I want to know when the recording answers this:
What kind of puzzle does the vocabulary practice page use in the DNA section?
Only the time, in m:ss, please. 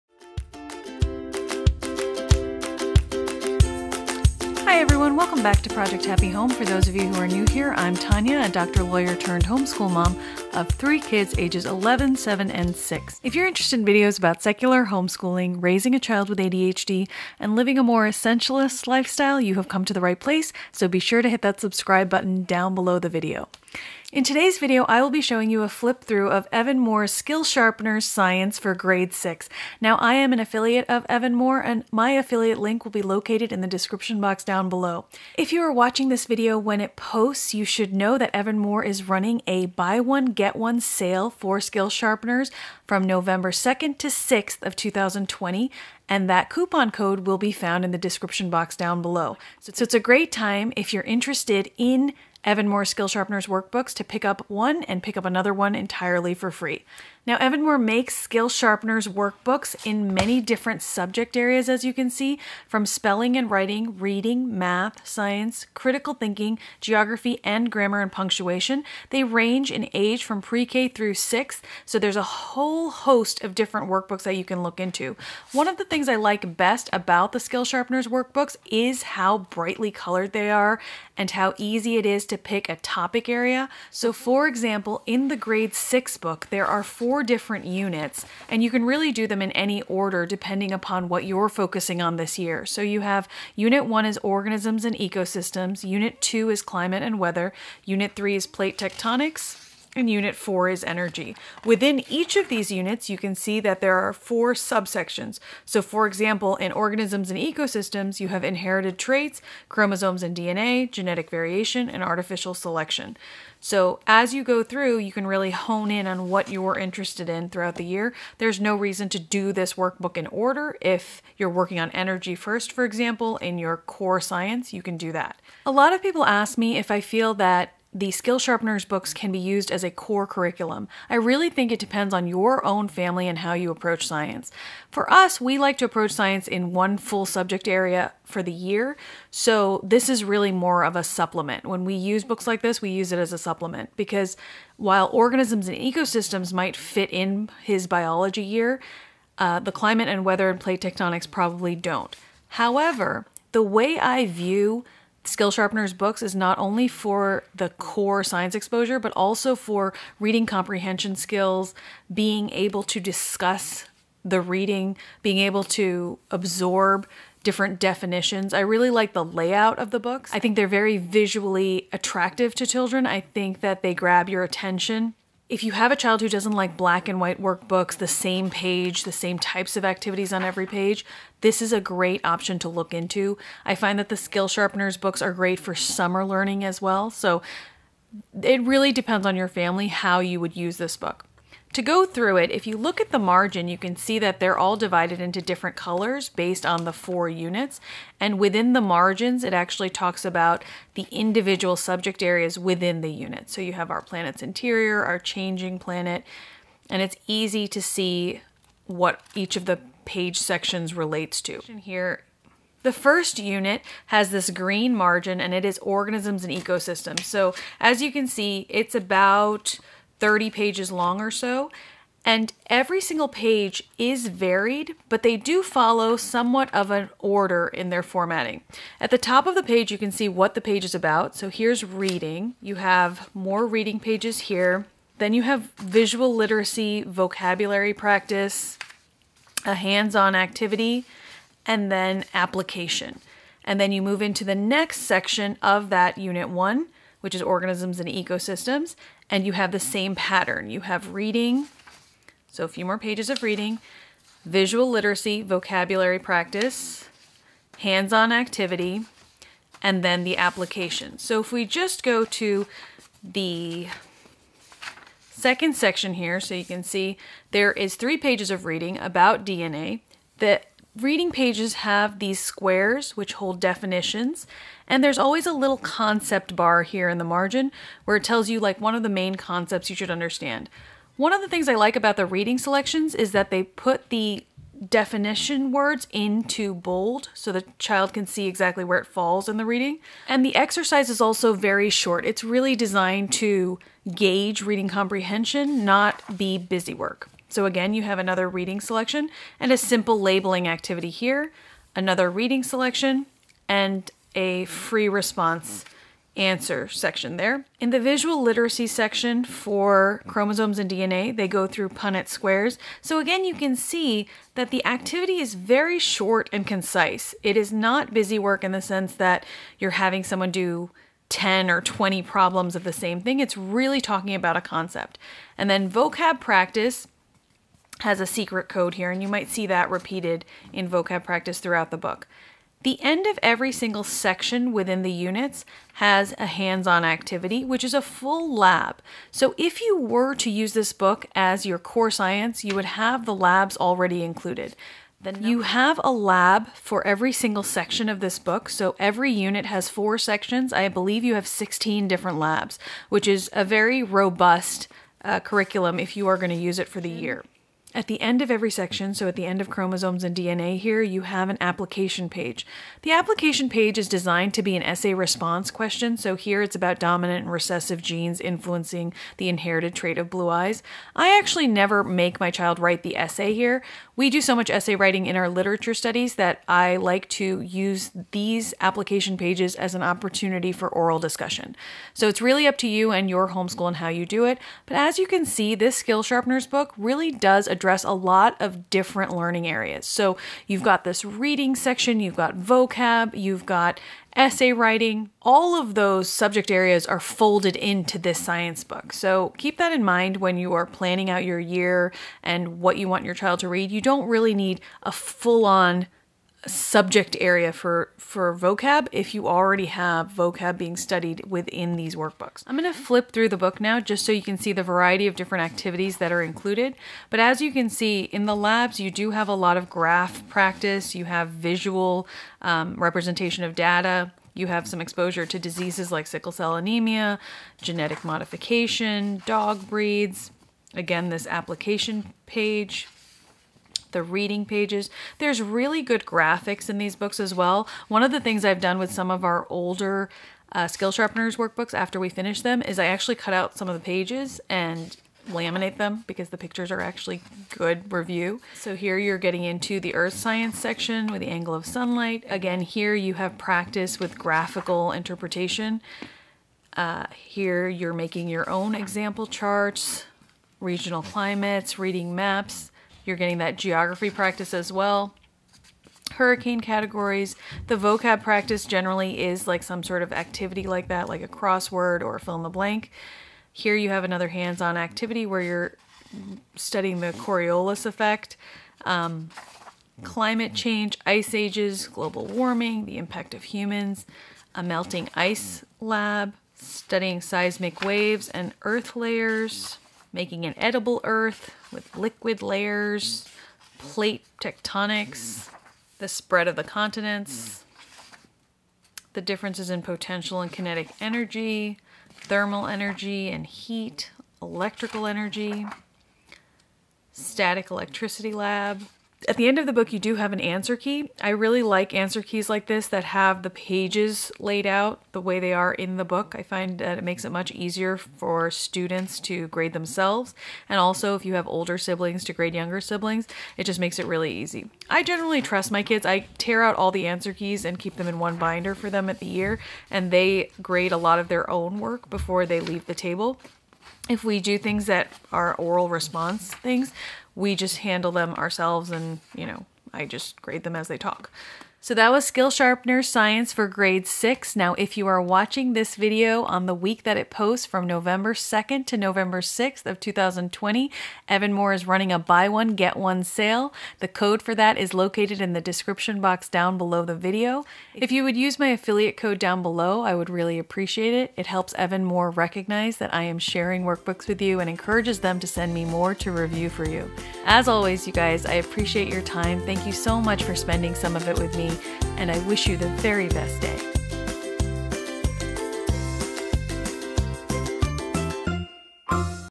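5:28.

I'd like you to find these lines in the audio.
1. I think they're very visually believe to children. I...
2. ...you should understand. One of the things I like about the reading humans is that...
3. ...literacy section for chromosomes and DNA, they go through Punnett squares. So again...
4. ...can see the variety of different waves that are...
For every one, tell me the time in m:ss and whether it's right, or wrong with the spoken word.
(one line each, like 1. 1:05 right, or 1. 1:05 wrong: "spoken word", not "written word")
1. 2:50 wrong: "attractive", not "believe"
2. 4:39 wrong: "selections", not "humans"
3. 5:08 right
4. 6:54 wrong: "activities", not "waves".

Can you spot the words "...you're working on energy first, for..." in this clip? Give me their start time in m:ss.
2:01.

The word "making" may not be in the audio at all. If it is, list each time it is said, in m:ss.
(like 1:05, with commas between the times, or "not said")
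7:38, 8:10.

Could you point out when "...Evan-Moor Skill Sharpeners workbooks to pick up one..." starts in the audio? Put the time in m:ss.
0:52.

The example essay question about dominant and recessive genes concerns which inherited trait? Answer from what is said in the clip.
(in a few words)
Blue eyes.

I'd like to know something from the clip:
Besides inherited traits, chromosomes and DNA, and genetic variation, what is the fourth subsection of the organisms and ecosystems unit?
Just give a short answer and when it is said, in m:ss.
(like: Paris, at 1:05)
Artificial selection, at 1:52.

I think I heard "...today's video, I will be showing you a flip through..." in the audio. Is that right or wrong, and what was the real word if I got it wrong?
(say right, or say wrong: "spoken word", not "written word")
right.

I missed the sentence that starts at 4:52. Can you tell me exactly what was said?
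It's really designed to gauge reading comprehension, not be busy work.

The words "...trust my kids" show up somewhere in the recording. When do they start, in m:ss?
8:45.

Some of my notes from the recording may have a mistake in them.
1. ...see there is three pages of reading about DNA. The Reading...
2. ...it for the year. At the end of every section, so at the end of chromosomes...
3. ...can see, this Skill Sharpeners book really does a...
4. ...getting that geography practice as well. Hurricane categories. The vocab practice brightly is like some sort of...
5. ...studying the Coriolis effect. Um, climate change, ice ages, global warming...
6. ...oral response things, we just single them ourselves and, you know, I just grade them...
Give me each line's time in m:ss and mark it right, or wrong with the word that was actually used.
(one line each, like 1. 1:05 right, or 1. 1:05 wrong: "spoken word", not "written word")
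1. 4:26 right
2. 5:56 right
3. 6:25 right
4. 7:43 wrong: "generally", not "brightly"
5. 7:56 right
6. 8:55 wrong: "handle", not "single".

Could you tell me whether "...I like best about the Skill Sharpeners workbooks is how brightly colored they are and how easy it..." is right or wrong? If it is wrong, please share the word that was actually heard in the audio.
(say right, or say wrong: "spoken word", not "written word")
right.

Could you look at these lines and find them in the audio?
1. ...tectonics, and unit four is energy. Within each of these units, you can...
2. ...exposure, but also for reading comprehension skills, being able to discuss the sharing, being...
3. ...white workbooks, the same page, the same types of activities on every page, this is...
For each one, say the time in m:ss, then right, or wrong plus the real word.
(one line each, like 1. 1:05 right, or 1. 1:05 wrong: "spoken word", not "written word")
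1. 1:38 right
2. 2:38 wrong: "reading", not "sharing"
3. 2:57 right.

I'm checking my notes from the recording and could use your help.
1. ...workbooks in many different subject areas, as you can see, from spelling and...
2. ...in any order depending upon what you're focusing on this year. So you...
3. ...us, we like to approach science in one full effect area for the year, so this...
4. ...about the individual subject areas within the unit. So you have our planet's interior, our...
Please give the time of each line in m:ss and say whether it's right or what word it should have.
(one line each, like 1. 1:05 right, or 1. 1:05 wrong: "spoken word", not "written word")
1. 0:59 right
2. 1:29 right
3. 2:15 wrong: "subject", not "effect"
4. 3:20 right.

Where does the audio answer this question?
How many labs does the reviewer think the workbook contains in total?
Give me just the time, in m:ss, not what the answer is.
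5:51.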